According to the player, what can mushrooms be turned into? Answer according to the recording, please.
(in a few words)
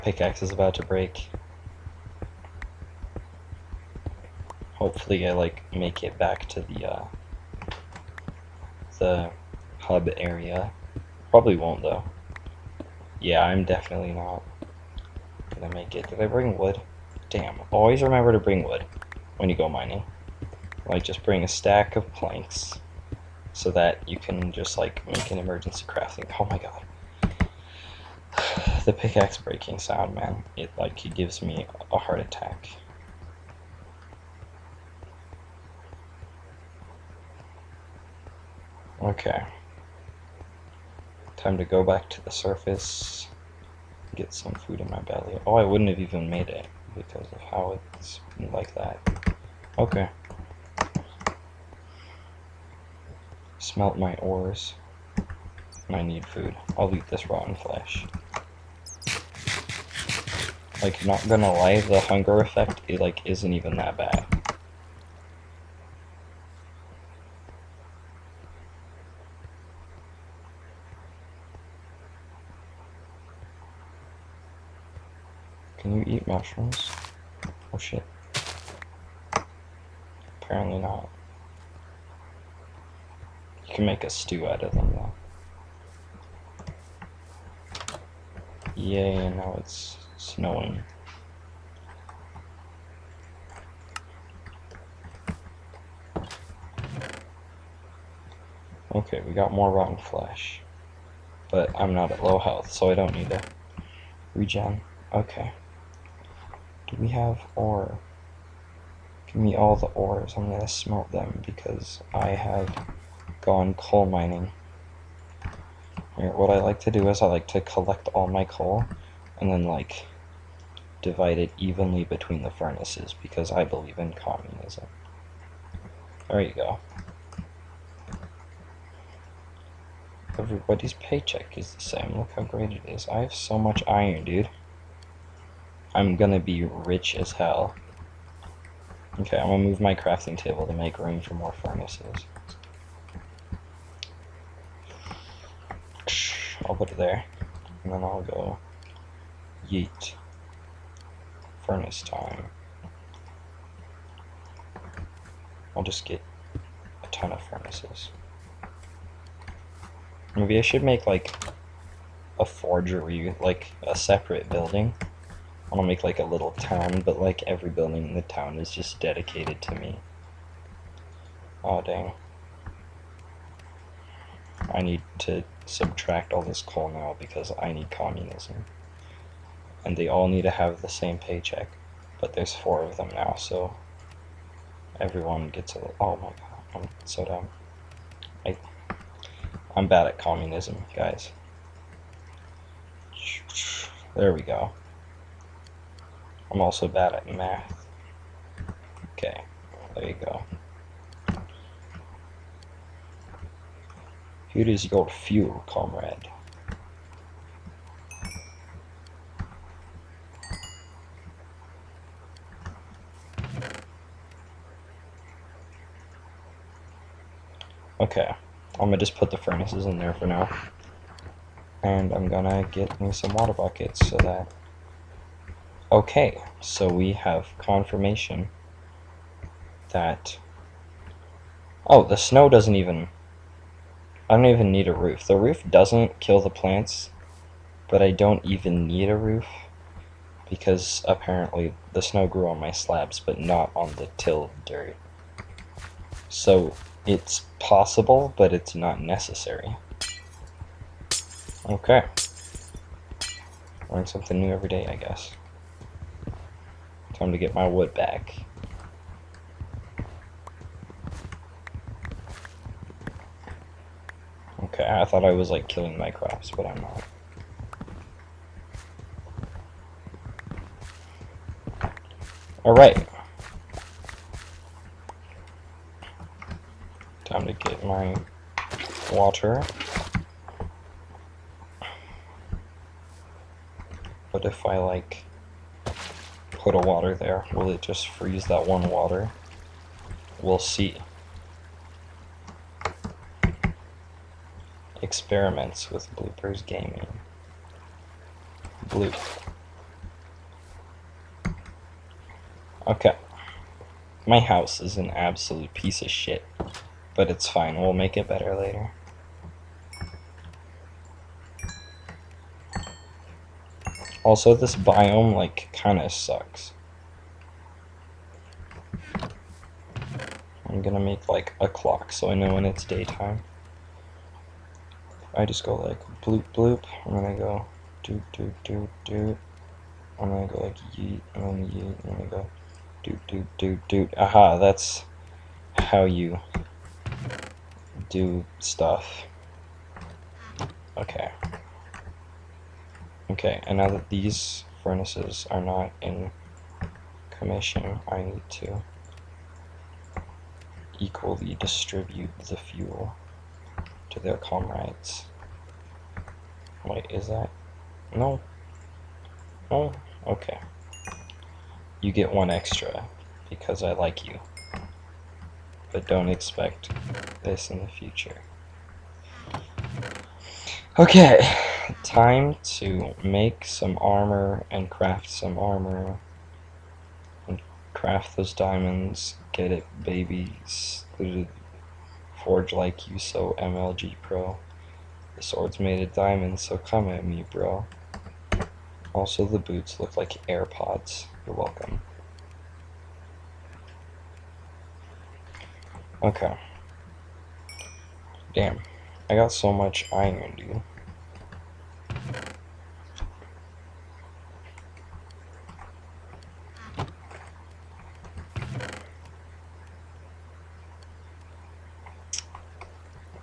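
A stew.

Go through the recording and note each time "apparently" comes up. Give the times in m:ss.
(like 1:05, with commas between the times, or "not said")
1:20, 4:01.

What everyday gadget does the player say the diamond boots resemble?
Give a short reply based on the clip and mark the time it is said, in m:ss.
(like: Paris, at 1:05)
AirPods, at 6:30.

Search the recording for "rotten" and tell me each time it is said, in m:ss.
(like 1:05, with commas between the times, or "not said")
0:57, 1:39.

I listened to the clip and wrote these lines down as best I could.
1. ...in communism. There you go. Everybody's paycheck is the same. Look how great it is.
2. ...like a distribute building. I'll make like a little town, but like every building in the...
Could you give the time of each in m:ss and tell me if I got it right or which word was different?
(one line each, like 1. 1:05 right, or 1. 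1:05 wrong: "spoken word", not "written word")
1. 2:03 right
2. 2:43 wrong: "separate", not "distribute".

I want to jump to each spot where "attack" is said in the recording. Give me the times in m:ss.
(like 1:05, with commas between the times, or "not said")
0:32.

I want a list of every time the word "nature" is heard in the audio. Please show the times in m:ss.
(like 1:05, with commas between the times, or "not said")
not said.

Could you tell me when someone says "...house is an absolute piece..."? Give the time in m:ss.
5:04.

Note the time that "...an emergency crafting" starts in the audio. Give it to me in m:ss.
0:25.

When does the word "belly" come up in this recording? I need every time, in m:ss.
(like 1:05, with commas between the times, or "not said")
0:44.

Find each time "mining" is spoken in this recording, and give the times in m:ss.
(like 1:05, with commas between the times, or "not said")
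0:19, 1:54.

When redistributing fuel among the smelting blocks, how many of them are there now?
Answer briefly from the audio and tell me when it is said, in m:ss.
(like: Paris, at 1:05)
4, at 3:02.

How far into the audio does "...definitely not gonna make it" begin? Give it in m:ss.
0:13.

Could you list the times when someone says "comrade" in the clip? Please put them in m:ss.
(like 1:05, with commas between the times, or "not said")
3:25, 5:54.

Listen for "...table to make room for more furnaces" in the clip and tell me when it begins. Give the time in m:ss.
2:20.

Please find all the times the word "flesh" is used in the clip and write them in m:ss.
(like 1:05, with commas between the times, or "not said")
0:57, 1:39.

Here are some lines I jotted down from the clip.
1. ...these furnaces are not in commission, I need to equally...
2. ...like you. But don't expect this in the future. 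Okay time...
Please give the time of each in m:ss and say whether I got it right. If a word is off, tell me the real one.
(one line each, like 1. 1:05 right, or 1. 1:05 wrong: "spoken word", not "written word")
1. 5:44 right
2. 6:03 right.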